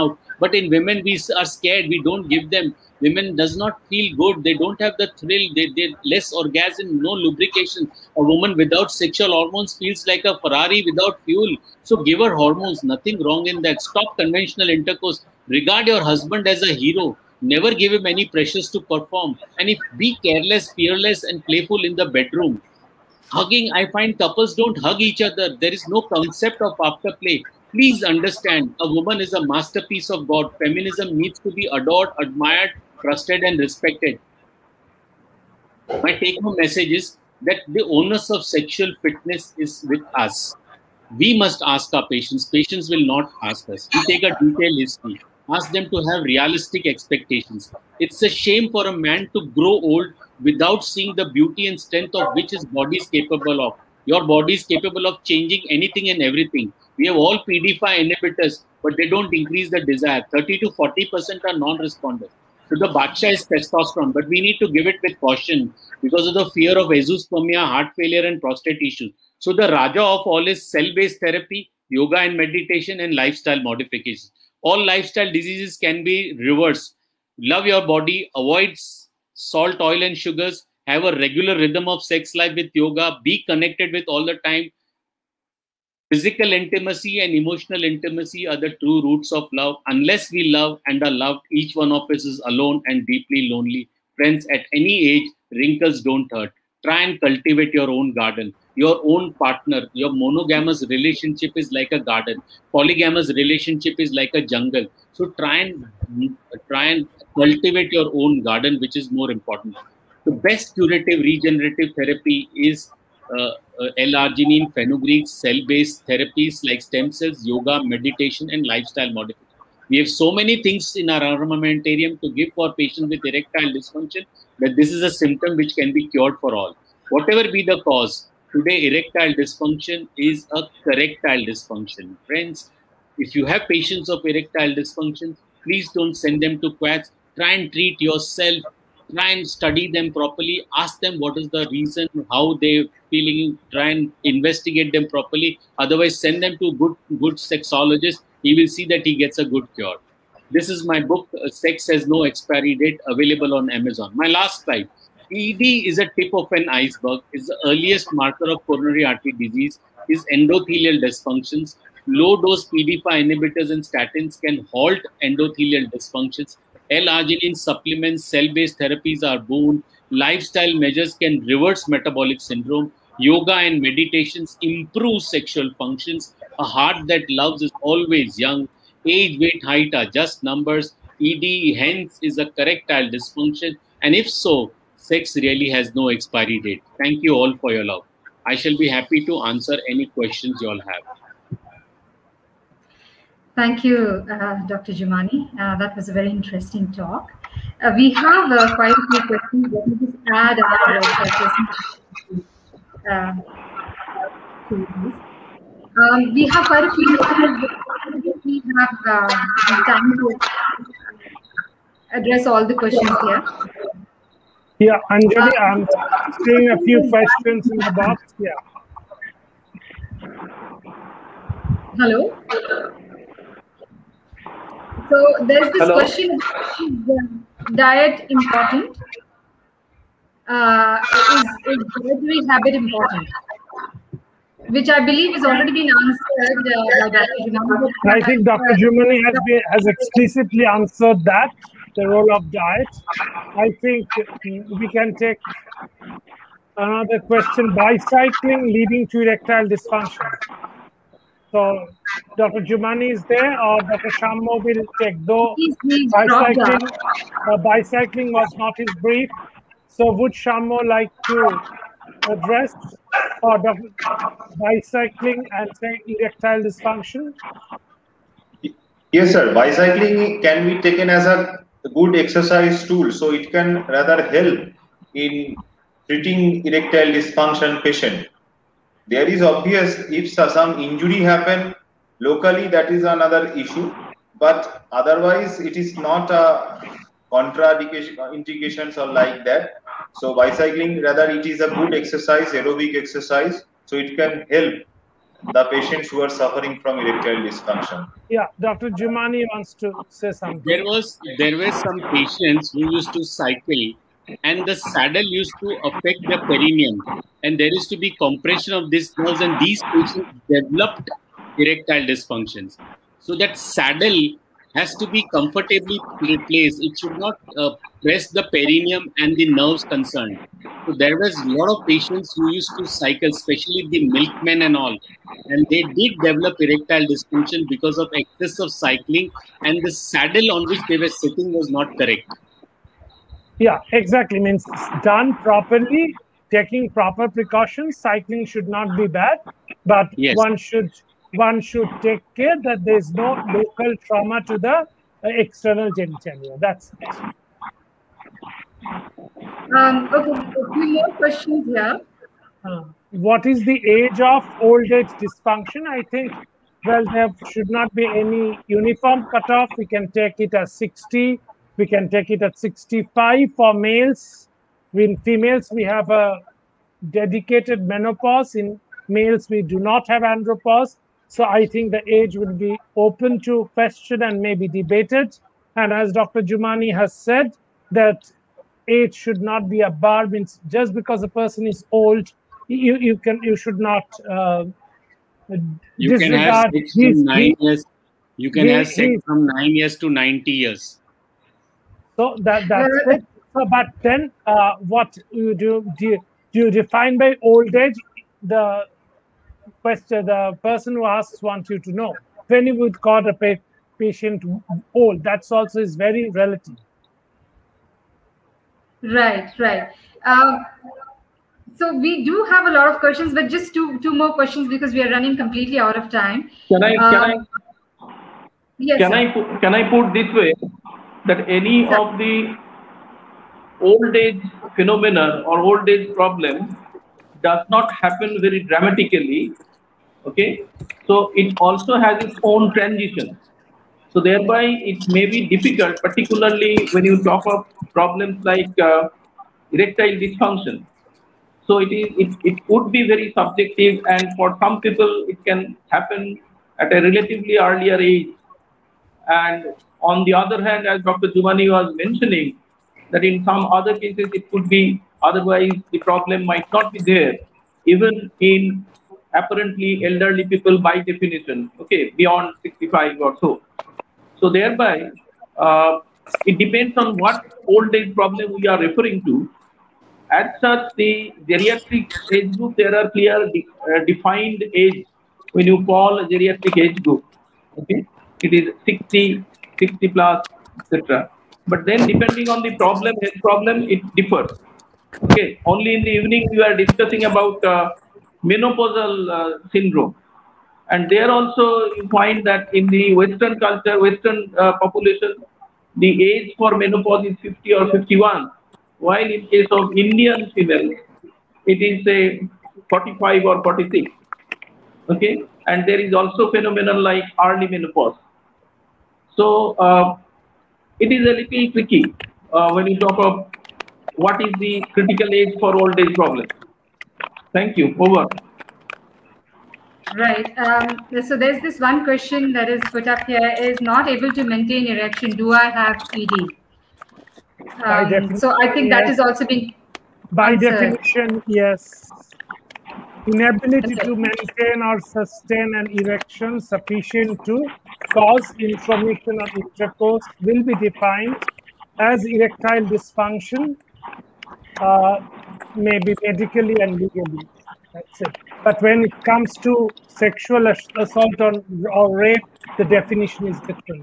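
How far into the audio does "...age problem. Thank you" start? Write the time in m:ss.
8:35.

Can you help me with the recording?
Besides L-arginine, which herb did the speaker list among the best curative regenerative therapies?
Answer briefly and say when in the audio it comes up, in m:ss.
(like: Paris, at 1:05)
fenugreek, at 1:54.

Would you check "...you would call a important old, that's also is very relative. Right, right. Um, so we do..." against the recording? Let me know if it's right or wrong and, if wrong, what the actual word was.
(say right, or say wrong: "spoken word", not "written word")
wrong: "patient", not "important".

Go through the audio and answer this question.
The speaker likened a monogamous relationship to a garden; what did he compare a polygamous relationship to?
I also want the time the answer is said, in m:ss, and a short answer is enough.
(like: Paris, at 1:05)
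a jungle, at 1:44.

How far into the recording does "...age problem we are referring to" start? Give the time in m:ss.
7:47.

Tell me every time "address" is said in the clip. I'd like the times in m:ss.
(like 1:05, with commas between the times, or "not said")
3:32, 4:22.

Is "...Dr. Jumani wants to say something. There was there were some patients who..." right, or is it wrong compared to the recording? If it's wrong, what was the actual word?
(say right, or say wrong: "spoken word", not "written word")
right.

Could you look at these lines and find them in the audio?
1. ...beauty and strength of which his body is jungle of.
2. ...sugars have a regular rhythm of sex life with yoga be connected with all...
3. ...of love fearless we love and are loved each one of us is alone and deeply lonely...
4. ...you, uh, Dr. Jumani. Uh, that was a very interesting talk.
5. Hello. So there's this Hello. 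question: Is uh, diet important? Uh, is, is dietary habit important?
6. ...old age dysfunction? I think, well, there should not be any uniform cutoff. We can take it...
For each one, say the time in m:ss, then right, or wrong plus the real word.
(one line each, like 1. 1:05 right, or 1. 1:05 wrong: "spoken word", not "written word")
1. 0:51 wrong: "capable", not "jungle"
2. 1:20 right
3. 1:29 wrong: "unless", not "fearless"
4. 3:13 right
5. 3:41 right
6. 5:54 right.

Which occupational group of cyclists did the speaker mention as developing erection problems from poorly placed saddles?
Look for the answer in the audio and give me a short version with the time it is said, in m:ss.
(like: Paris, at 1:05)
milkmen, at 5:24.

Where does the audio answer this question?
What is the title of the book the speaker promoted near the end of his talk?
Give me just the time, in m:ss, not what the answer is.
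2:31.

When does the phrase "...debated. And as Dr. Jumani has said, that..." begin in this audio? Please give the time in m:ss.
6:14.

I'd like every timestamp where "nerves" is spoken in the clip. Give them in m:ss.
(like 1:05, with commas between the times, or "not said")
5:09, 5:19.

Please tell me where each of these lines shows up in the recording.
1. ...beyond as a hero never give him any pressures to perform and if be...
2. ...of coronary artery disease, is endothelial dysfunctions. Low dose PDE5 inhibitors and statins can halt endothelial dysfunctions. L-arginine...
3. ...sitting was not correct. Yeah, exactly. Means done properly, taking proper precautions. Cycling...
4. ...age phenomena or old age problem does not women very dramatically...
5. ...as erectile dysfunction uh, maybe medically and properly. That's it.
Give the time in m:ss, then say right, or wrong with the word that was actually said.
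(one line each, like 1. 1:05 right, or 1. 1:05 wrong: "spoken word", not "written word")
1. 0:16 wrong: "husband", not "beyond"
2. 2:38 right
3. 5:31 right
4. 7:04 wrong: "happen", not "women"
5. 9:01 wrong: "legally", not "properly".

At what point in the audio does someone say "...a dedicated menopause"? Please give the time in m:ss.
6:06.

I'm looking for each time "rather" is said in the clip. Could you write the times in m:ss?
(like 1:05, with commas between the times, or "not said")
4:33, 4:51.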